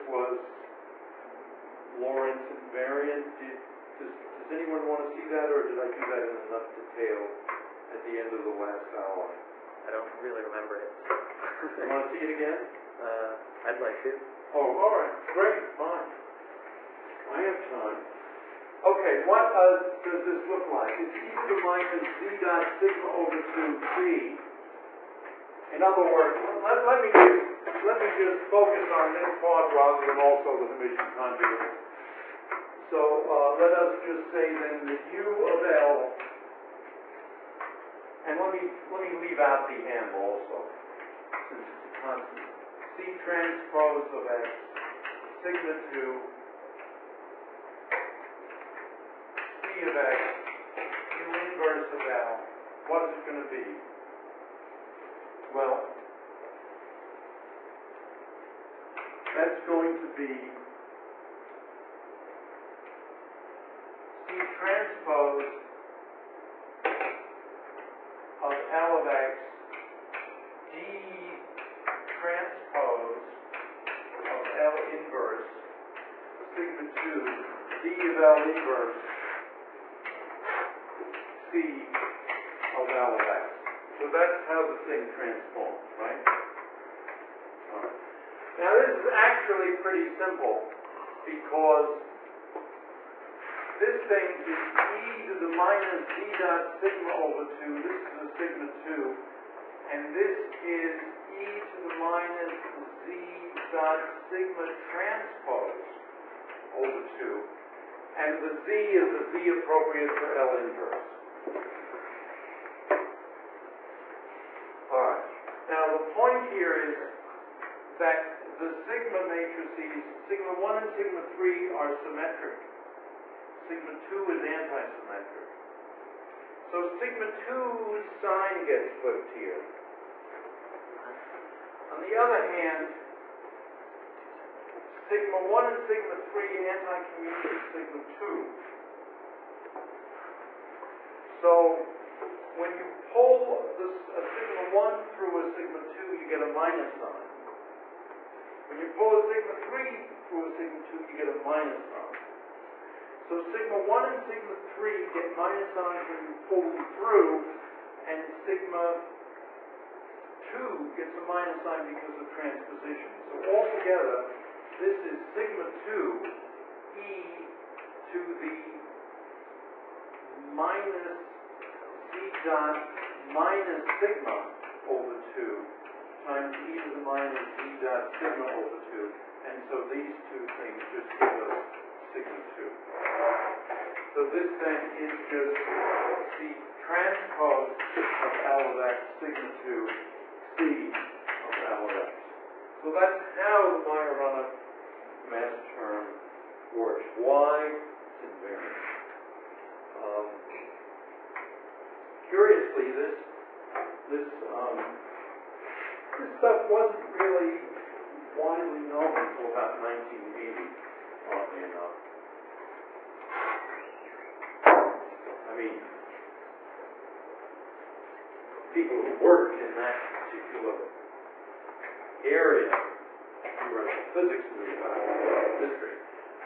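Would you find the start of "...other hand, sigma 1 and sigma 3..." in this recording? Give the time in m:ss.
2:12.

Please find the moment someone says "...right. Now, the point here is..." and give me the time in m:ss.
1:55.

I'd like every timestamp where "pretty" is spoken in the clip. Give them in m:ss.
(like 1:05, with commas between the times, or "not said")
1:29.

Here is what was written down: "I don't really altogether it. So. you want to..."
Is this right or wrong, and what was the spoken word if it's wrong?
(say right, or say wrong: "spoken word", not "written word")
wrong: "remember", not "altogether".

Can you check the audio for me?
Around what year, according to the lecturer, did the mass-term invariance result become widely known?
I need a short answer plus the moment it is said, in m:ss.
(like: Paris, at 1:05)
1980, at 3:29.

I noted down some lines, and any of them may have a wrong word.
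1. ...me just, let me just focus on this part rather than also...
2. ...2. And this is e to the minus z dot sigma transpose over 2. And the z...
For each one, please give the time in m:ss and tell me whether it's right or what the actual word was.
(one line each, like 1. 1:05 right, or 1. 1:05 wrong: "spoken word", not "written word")
1. 0:27 right
2. 1:38 right.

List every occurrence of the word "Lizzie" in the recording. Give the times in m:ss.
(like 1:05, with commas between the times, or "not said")
not said.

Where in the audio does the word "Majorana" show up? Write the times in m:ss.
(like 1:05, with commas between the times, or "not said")
3:13.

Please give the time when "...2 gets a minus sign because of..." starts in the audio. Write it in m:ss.
2:40.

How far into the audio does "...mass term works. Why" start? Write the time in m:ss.
3:15.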